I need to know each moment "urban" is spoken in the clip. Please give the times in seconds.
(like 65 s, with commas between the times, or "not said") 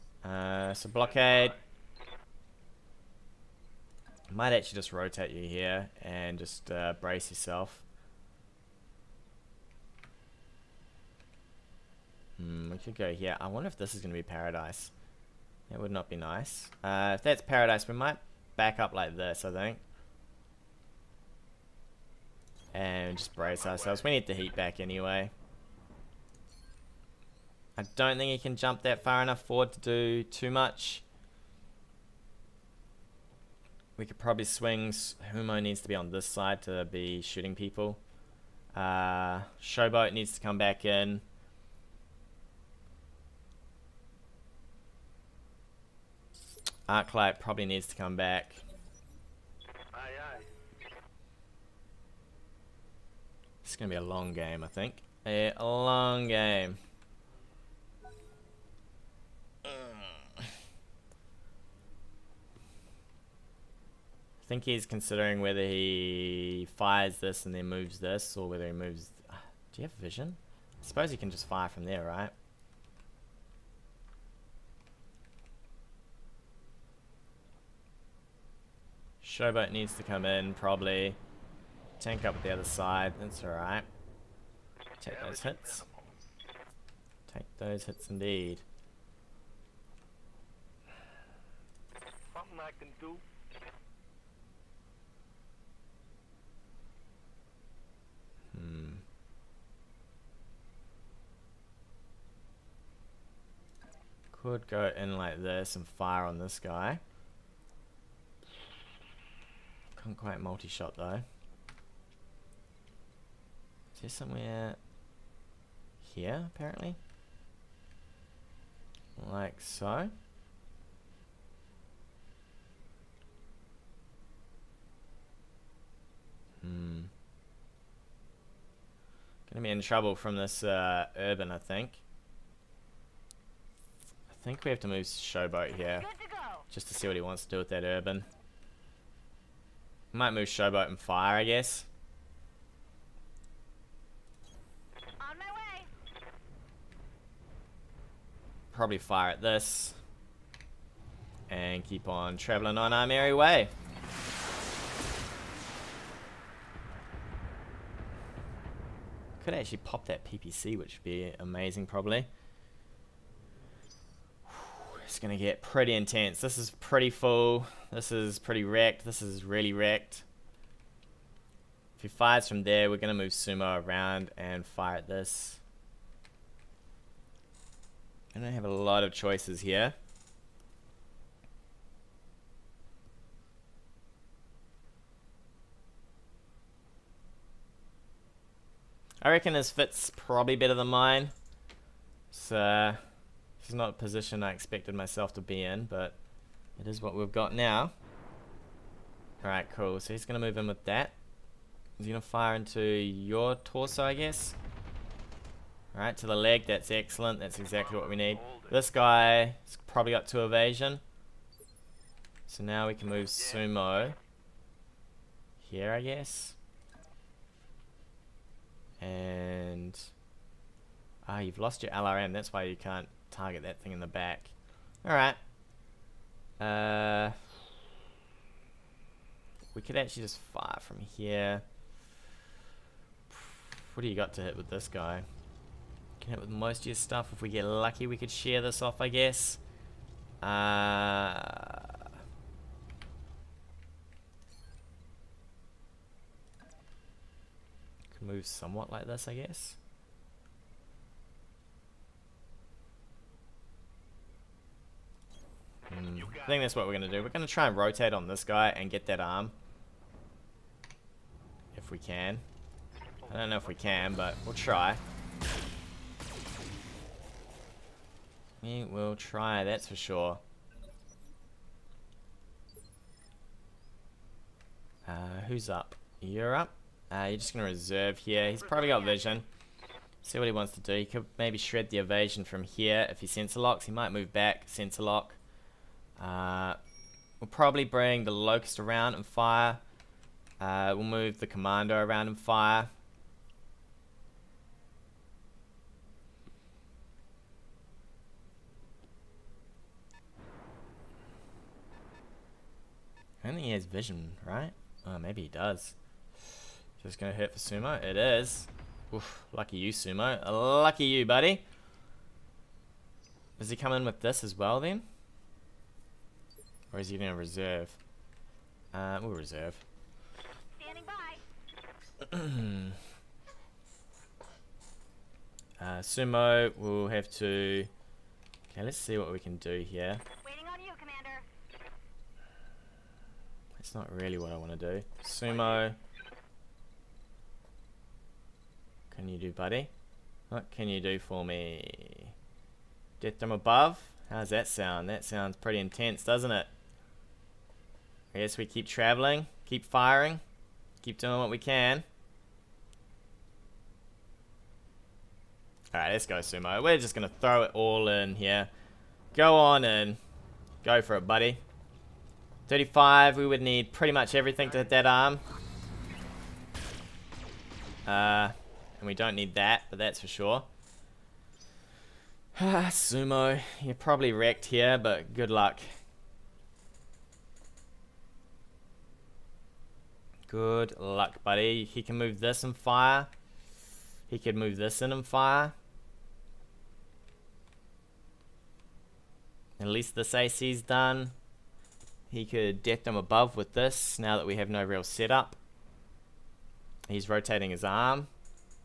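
131 s, 137 s.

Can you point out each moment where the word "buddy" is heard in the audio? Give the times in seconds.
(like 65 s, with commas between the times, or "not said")
311 s, 339 s, 361 s, 381 s.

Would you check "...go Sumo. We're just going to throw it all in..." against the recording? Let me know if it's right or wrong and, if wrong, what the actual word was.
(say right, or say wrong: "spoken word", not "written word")
right.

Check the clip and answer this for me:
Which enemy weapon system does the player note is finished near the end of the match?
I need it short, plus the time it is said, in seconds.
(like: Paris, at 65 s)
AC, at 390 s.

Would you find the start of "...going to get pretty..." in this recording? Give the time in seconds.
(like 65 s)
165 s.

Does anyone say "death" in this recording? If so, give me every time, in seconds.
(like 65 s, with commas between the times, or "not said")
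343 s, 392 s.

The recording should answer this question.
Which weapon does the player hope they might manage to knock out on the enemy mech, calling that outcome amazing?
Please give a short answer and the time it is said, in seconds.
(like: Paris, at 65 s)
PPC, at 160 s.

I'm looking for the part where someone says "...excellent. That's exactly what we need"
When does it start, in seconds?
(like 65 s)
206 s.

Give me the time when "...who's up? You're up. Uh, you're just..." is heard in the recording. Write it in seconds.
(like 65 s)
275 s.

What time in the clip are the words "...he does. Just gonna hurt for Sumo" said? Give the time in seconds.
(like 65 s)
305 s.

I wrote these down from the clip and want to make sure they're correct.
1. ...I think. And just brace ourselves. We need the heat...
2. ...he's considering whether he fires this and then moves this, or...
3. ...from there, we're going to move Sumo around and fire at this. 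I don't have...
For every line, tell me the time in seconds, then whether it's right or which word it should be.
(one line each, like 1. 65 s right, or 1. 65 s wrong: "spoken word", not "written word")
1. 19 s right
2. 64 s right
3. 172 s right.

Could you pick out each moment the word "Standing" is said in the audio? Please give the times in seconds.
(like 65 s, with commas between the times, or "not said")
320 s.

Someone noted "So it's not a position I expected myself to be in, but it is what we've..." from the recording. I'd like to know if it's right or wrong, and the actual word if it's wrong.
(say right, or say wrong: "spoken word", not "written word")
right.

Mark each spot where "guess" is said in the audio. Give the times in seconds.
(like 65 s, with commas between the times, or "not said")
141 s, 204 s, 215 s, 239 s, 249 s, 348 s.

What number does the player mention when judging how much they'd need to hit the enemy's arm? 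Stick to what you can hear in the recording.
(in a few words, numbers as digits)
35.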